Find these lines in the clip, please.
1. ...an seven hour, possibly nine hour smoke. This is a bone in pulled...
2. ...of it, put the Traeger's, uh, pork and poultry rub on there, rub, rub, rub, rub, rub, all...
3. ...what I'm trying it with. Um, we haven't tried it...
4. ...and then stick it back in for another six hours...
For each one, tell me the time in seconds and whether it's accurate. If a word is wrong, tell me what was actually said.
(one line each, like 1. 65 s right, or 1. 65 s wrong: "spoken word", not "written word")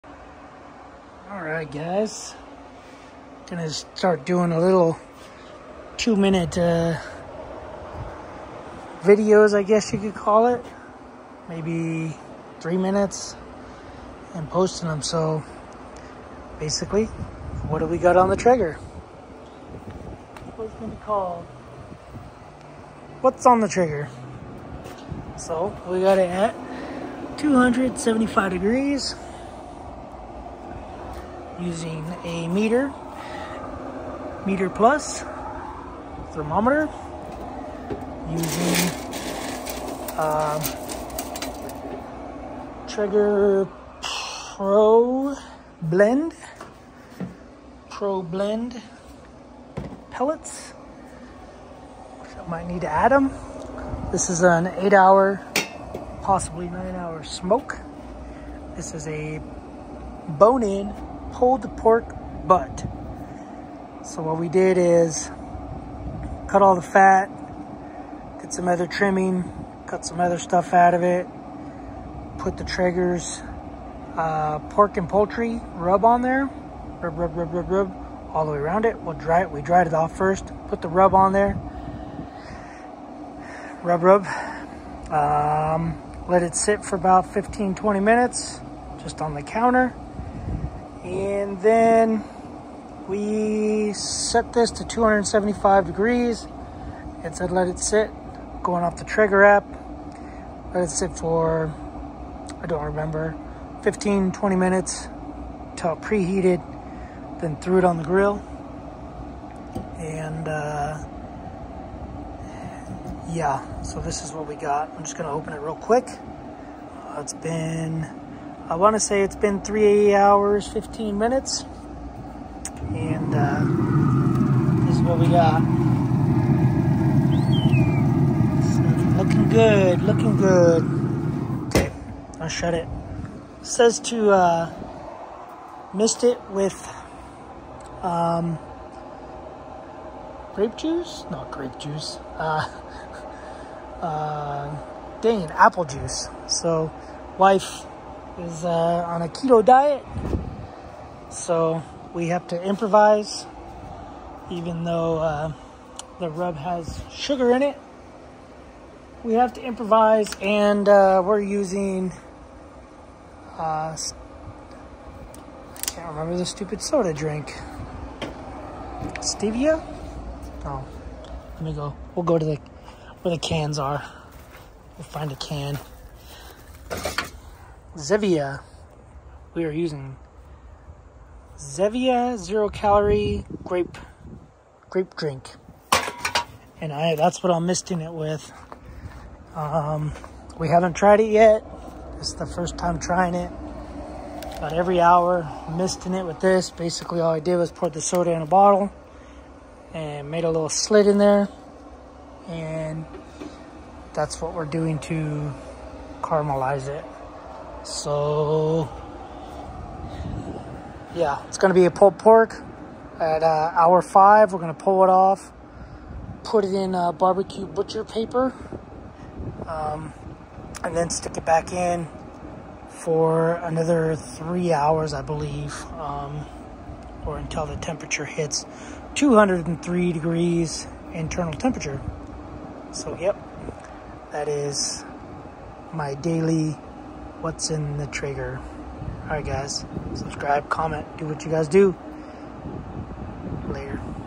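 1. 54 s wrong: "eight", not "seven"
2. 70 s right
3. 187 s wrong: "misting", not "trying"
4. 220 s wrong: "three", not "six".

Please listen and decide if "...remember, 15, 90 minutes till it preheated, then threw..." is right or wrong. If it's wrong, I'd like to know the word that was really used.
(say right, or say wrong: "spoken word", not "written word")
wrong: "20", not "90".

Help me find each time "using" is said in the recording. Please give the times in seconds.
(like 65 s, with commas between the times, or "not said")
31 s, 38 s, 161 s, 179 s.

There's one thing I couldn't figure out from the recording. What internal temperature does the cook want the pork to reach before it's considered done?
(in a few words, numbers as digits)
203 degrees.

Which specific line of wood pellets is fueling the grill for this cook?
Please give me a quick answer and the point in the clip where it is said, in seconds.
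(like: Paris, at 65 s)
Pro Blend, at 42 s.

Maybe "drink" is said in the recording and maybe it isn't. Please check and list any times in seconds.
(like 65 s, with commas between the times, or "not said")
167 s, 185 s.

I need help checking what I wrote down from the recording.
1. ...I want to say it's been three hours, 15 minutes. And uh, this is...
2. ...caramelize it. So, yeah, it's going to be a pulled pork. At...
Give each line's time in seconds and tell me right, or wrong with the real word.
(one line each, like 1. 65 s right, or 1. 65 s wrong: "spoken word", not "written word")
1. 118 s right
2. 206 s right.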